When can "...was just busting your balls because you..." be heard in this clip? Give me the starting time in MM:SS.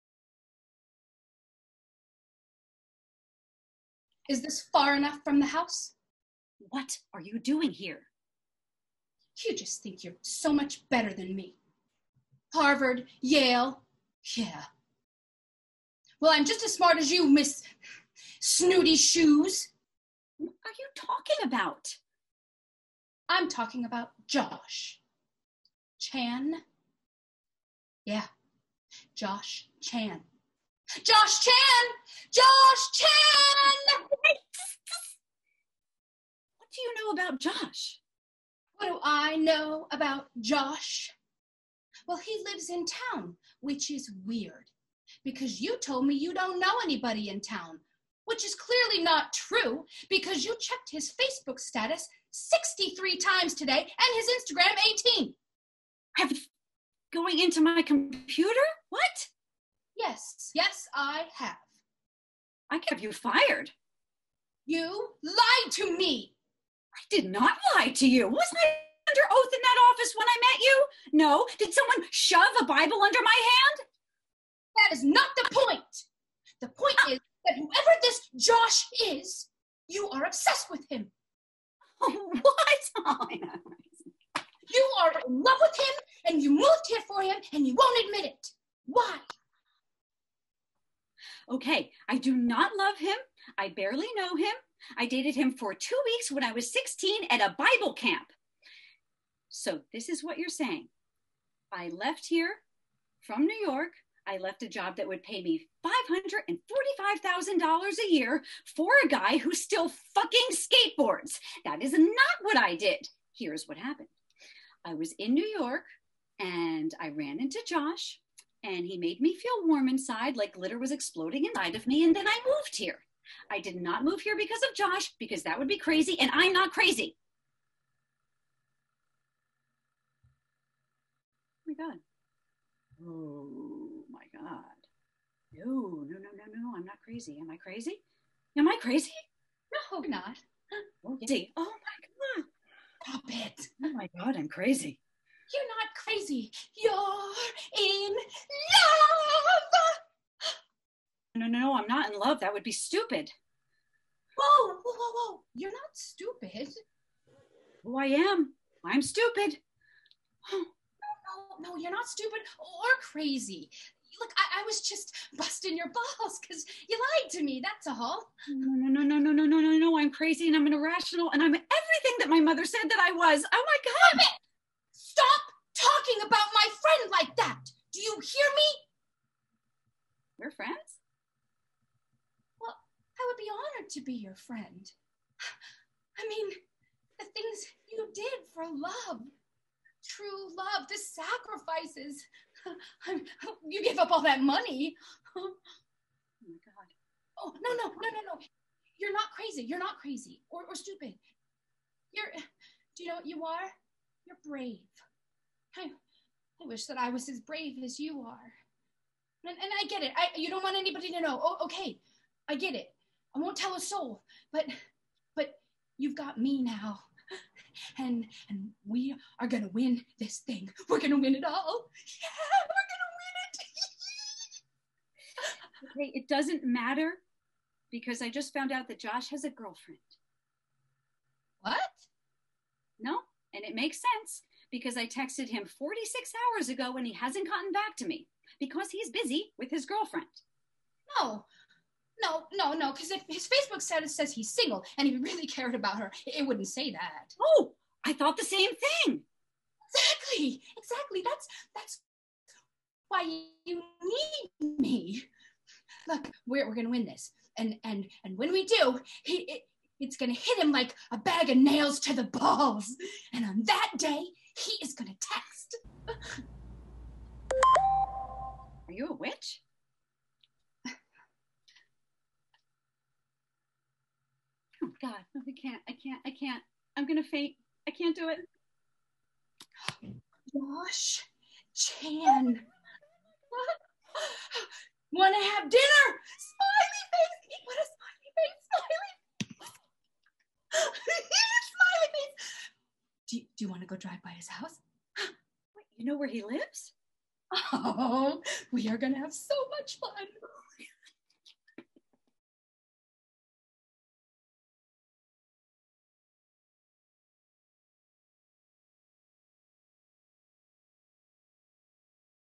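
02:44.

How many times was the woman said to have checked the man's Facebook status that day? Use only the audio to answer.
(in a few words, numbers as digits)
63.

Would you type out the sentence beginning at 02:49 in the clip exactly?
I'm crazy and I'm an irrational and I'm everything that my mother said that I was.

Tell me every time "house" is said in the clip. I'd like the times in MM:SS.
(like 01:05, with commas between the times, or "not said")
00:05, 04:54.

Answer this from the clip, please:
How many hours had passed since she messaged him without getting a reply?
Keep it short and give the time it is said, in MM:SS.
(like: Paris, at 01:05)
46, at 03:55.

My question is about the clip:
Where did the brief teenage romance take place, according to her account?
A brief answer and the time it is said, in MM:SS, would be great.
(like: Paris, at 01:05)
Bible camp, at 01:37.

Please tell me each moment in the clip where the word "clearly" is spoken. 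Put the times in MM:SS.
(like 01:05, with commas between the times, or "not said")
00:48.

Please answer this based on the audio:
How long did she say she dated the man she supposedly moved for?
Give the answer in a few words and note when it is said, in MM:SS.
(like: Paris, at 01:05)
two weeks, at 01:35.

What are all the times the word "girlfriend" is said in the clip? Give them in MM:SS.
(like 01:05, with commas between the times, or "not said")
03:49, 03:59.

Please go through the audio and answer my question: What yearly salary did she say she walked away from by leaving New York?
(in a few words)
$545,000.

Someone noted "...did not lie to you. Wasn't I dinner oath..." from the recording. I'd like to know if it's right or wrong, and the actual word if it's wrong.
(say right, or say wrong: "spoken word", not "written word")
wrong: "under", not "dinner".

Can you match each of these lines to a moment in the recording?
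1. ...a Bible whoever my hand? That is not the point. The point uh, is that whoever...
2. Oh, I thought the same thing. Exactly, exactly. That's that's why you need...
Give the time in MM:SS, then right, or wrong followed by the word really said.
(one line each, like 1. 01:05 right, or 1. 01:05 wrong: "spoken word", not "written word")
1. 01:12 wrong: "under", not "whoever"
2. 04:07 right.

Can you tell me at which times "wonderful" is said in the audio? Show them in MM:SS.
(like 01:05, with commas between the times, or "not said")
not said.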